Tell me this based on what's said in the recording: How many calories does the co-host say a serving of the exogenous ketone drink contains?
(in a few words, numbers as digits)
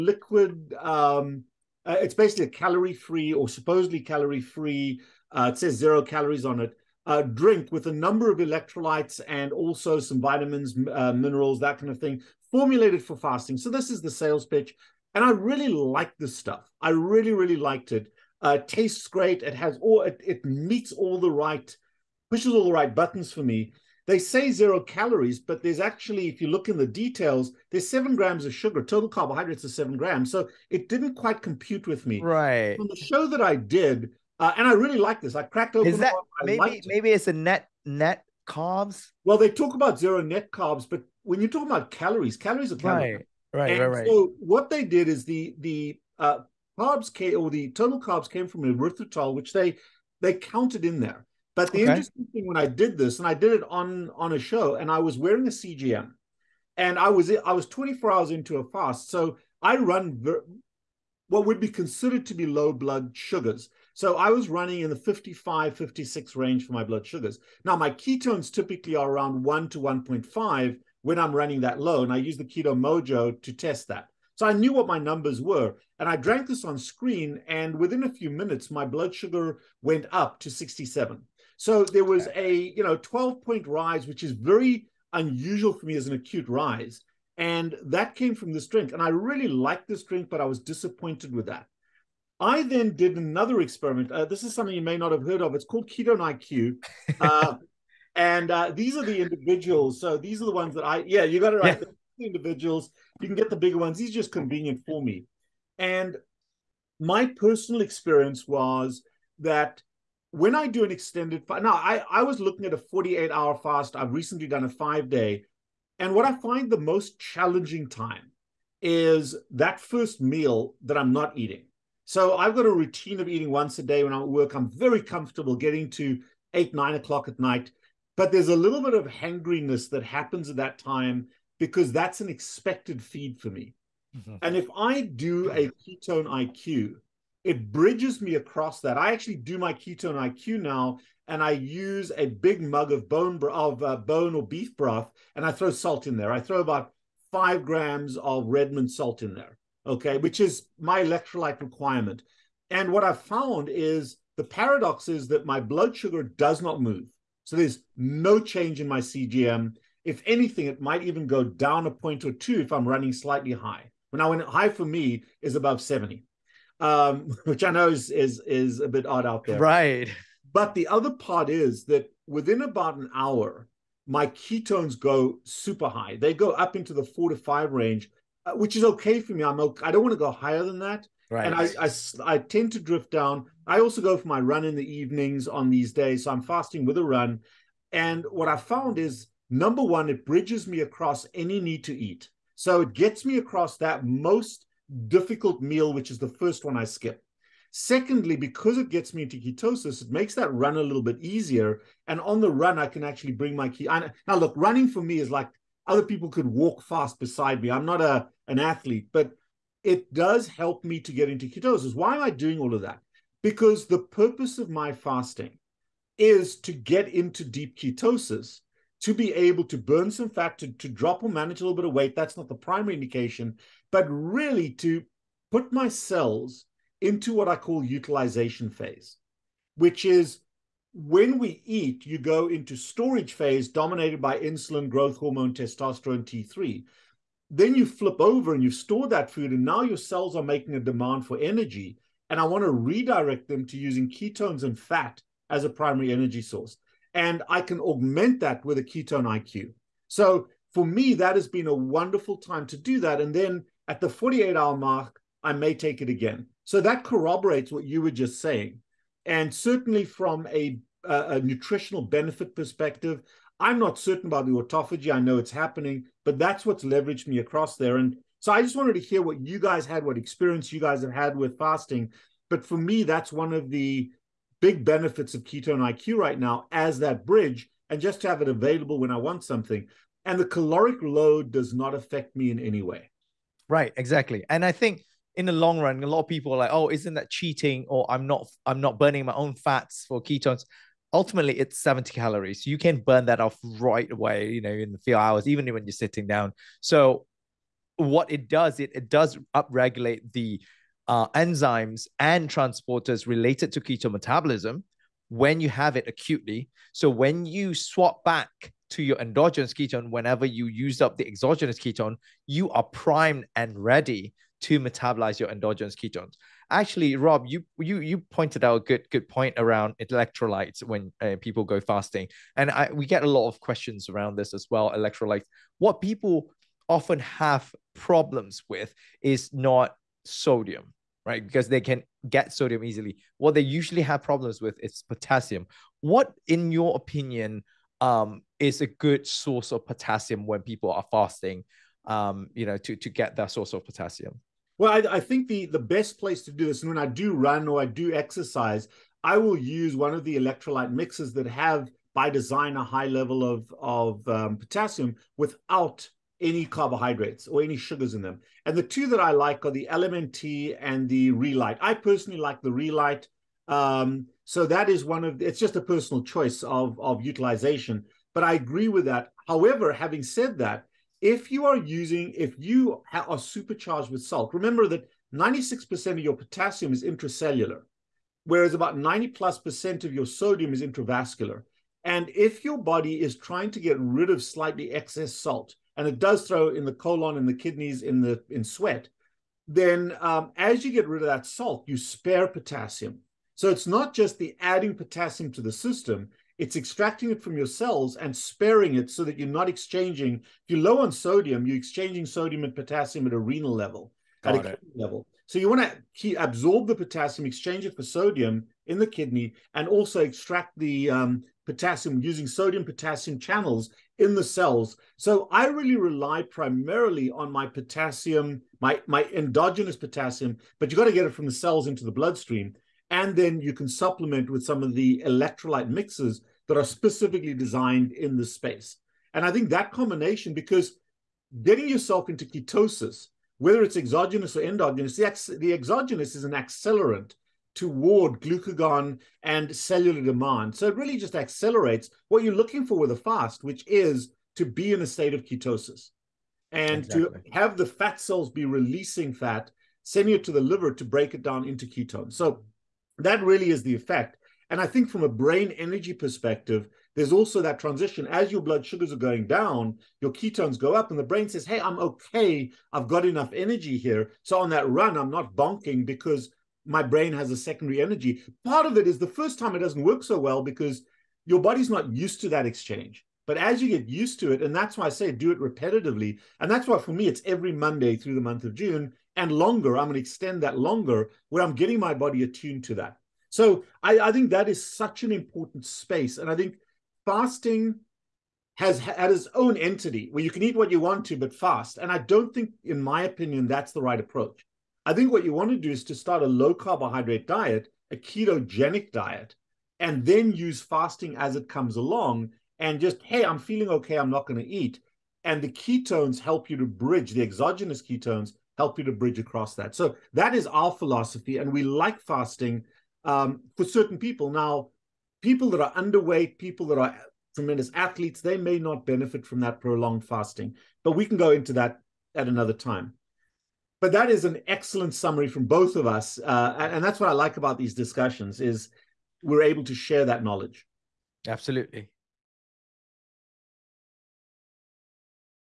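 70.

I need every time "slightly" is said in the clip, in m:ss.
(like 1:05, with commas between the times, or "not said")
2:43, 6:24.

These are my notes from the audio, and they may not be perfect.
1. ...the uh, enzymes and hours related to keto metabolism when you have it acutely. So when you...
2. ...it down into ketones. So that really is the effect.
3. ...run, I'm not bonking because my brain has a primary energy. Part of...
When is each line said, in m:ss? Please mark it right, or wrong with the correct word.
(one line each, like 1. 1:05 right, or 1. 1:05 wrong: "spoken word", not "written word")
1. 5:00 wrong: "transporters", not "hours"
2. 7:31 right
3. 7:44 wrong: "secondary", not "primary".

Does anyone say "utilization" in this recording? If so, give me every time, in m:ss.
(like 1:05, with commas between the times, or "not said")
3:47, 6:07.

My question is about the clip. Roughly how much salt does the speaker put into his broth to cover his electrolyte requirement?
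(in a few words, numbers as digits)
5 grams.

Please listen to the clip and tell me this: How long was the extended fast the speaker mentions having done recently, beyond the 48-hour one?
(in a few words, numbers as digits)
5 days.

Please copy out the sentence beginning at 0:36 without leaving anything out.
maybe it's a net net carbs?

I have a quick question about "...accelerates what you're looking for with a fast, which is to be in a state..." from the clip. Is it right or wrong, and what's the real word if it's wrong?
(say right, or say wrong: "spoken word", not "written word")
right.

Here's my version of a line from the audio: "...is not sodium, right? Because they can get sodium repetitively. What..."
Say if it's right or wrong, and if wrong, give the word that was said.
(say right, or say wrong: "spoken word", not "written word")
wrong: "easily", not "repetitively".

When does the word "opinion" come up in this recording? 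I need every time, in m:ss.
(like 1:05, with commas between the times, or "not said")
5:36, 8:13.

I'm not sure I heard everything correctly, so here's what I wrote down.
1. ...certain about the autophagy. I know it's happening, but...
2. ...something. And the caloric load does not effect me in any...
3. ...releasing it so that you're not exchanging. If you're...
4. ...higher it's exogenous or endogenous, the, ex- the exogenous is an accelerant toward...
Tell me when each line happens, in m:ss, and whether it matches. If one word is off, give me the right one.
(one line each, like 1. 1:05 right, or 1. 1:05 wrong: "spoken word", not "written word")
1. 4:23 right
2. 4:39 wrong: "affect", not "effect"
3. 6:38 wrong: "sparing", not "releasing"
4. 7:13 wrong: "whether", not "higher".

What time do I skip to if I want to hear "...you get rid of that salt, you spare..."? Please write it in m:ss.
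6:30.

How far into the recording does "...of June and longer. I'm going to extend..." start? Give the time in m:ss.
7:58.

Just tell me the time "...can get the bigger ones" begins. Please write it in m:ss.
1:43.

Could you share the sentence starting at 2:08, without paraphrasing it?
But there's a little bit of hangriness that happens at that time because that's an expected feed for me.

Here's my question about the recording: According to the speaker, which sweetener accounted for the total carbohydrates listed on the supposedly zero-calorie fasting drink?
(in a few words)
Erythritol.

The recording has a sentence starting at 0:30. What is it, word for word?
So it didn't quite compute with me.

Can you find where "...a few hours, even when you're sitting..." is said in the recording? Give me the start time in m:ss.
4:54.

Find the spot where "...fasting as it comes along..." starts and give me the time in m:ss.
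8:20.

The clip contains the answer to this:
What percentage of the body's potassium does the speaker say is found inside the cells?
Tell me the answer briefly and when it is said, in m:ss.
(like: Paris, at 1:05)
96%, at 6:15.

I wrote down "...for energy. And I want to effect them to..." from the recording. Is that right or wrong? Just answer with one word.
wrong.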